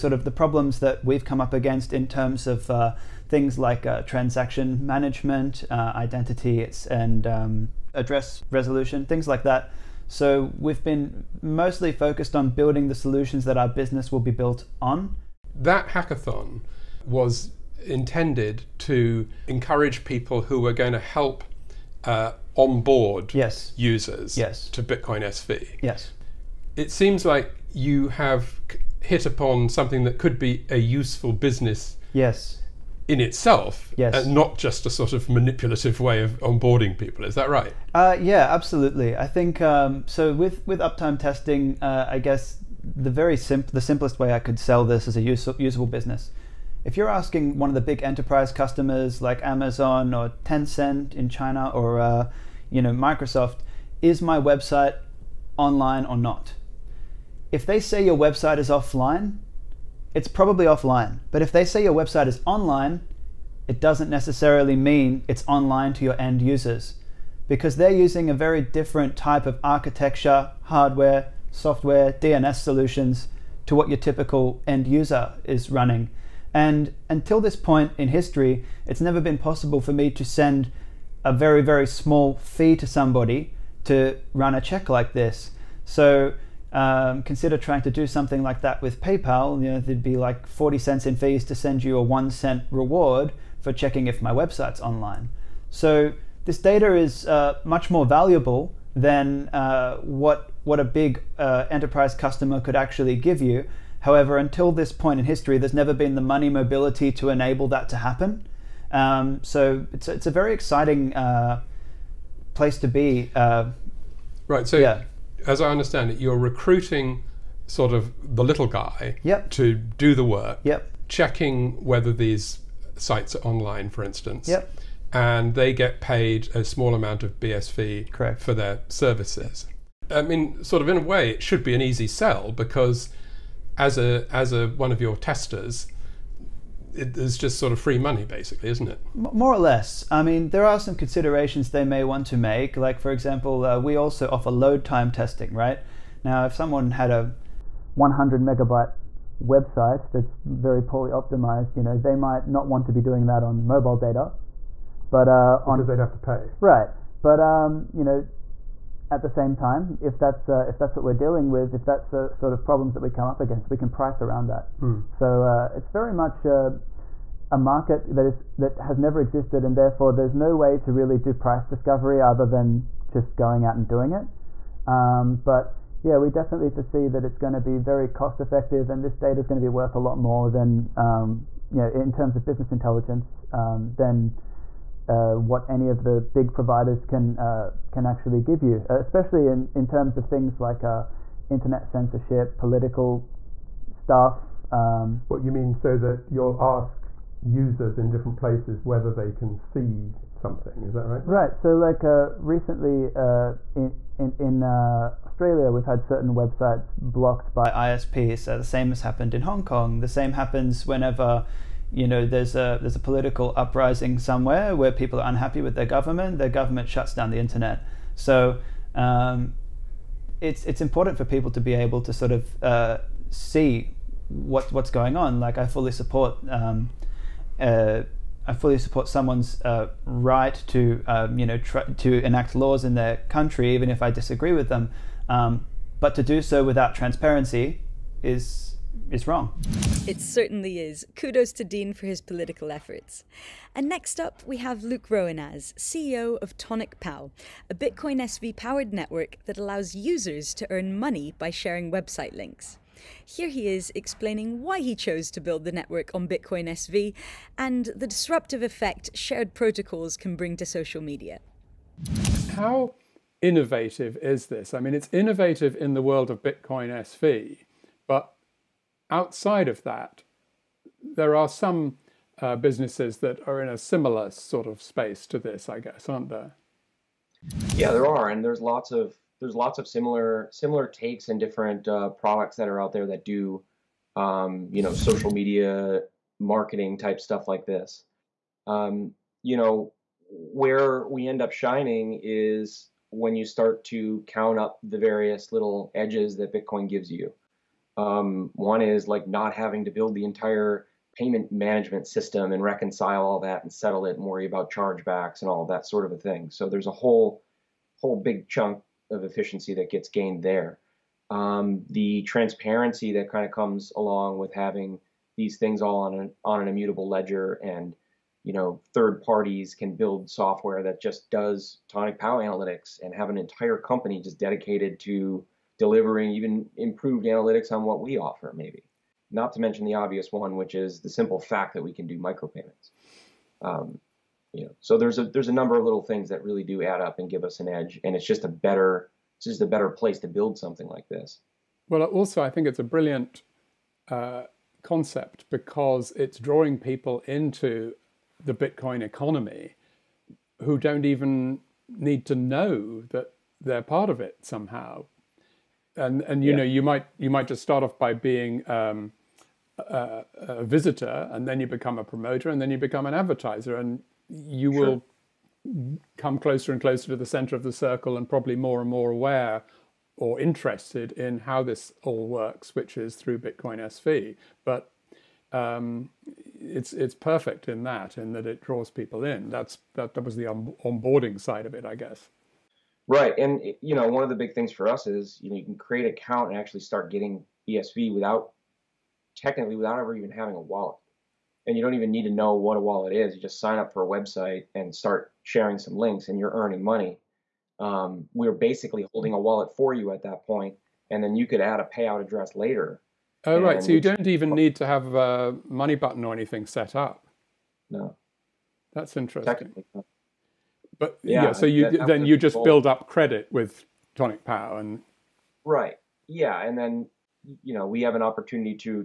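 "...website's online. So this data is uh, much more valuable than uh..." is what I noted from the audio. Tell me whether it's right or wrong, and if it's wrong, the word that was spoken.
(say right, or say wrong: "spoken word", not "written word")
right.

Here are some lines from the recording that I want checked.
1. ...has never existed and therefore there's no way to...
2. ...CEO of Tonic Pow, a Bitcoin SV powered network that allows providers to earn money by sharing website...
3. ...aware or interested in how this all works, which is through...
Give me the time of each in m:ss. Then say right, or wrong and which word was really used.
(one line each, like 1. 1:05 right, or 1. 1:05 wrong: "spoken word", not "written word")
1. 2:48 right
2. 4:05 wrong: "users", not "providers"
3. 6:09 right.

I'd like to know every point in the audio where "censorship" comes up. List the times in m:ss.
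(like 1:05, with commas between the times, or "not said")
3:11.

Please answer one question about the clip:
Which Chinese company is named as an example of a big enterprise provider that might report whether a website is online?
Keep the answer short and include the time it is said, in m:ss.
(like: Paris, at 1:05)
Tencent, at 0:50.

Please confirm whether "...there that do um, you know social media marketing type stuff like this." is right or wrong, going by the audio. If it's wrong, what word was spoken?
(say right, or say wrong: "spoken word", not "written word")
right.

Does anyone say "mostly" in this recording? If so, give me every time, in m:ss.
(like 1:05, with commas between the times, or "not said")
0:11.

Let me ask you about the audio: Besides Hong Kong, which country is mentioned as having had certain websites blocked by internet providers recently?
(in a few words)
Australia.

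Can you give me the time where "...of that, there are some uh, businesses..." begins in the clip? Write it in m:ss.
4:29.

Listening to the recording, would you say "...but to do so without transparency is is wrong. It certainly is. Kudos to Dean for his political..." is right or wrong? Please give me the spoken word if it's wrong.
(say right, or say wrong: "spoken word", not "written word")
right.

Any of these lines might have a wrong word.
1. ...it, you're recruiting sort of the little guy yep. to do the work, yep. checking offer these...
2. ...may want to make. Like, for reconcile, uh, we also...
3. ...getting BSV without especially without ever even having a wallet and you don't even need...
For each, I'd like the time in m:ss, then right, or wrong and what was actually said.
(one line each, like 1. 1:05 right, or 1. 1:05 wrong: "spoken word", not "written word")
1. 1:56 wrong: "whether", not "offer"
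2. 2:21 wrong: "example", not "reconcile"
3. 6:27 wrong: "technically", not "especially".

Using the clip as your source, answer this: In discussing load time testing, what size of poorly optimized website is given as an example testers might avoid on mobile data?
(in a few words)
100 megabytes.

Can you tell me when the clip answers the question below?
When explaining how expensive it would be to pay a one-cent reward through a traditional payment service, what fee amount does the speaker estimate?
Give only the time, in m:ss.
1:30.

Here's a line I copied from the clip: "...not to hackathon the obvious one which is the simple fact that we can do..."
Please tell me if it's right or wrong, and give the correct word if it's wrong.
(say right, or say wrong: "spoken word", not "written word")
wrong: "mention", not "hackathon".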